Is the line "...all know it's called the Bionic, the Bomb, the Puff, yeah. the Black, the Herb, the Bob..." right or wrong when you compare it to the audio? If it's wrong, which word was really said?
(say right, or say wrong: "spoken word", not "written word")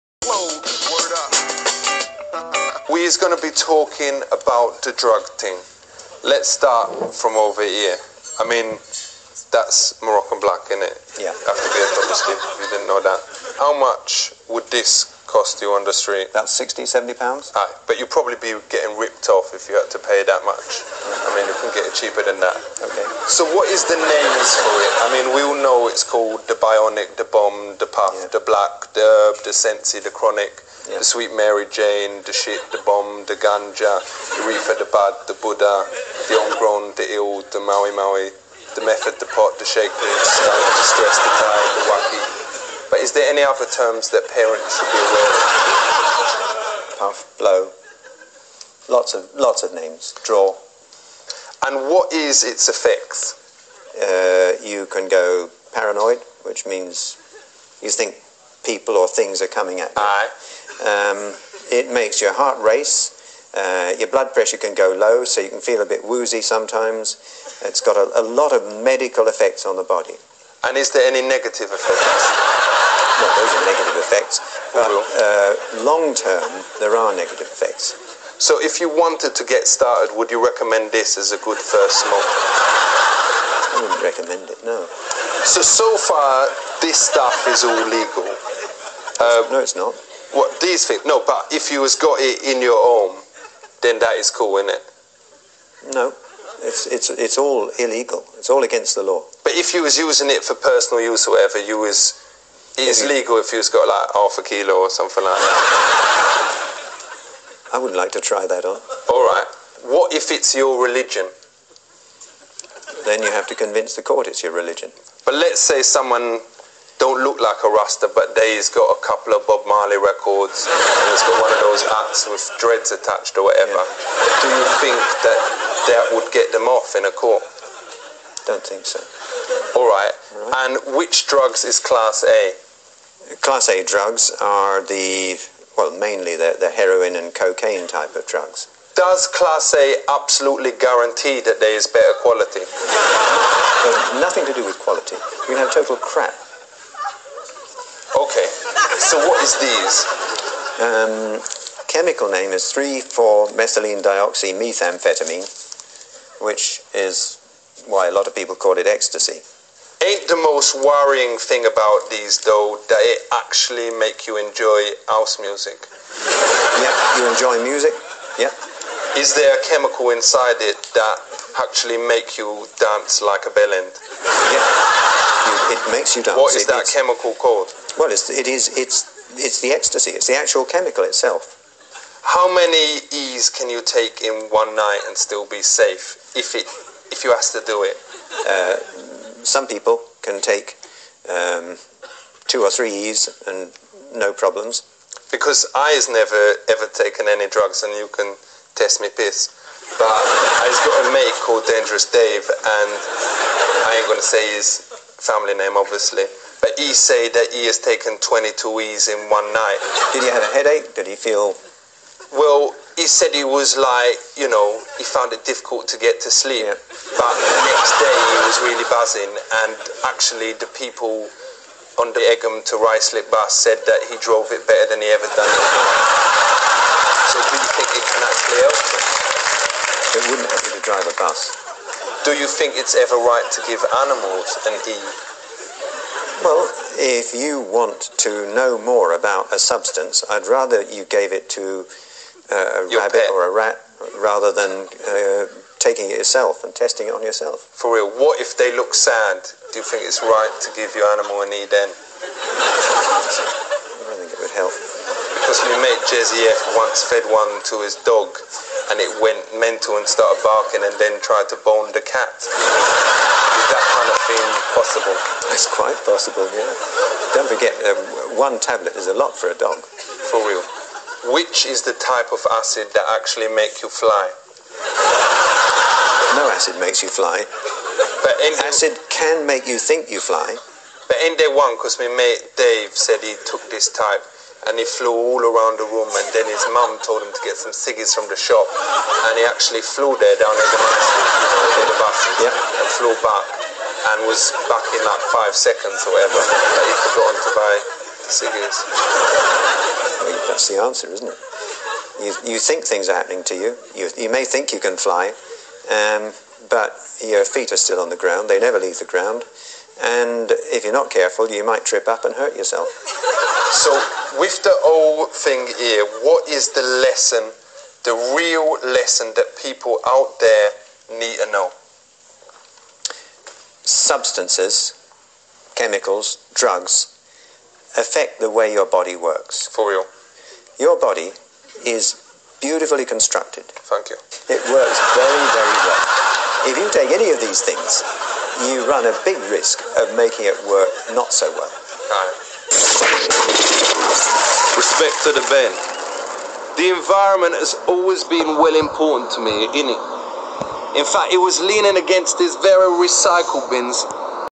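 wrong: "Sensi", not "Bob".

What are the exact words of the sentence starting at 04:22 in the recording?
Is that kind of thing possible?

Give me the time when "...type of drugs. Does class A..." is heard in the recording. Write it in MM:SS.
02:17.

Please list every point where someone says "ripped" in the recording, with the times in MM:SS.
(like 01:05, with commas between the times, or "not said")
00:18.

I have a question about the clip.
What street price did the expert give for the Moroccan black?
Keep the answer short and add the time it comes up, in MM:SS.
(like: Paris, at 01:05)
60-70 pounds, at 00:16.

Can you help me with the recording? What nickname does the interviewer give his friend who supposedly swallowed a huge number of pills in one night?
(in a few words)
Dangerous Dave.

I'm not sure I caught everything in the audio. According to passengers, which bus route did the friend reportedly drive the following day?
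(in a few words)
Egham to Ruislip.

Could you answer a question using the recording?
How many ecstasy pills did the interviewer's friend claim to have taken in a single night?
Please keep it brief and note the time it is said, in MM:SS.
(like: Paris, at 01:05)
22, at 03:28.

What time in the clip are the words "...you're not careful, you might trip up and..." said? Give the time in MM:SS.
05:10.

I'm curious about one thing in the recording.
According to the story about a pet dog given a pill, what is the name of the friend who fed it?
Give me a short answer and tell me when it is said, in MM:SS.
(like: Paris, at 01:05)
Jesse F, at 04:16.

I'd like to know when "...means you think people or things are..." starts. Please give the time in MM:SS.
00:56.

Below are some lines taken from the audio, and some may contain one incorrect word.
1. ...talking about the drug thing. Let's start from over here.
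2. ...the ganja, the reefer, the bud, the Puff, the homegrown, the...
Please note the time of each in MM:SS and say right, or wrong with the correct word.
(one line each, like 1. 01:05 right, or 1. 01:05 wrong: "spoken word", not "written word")
1. 00:03 right
2. 00:33 wrong: "Buddha", not "Puff".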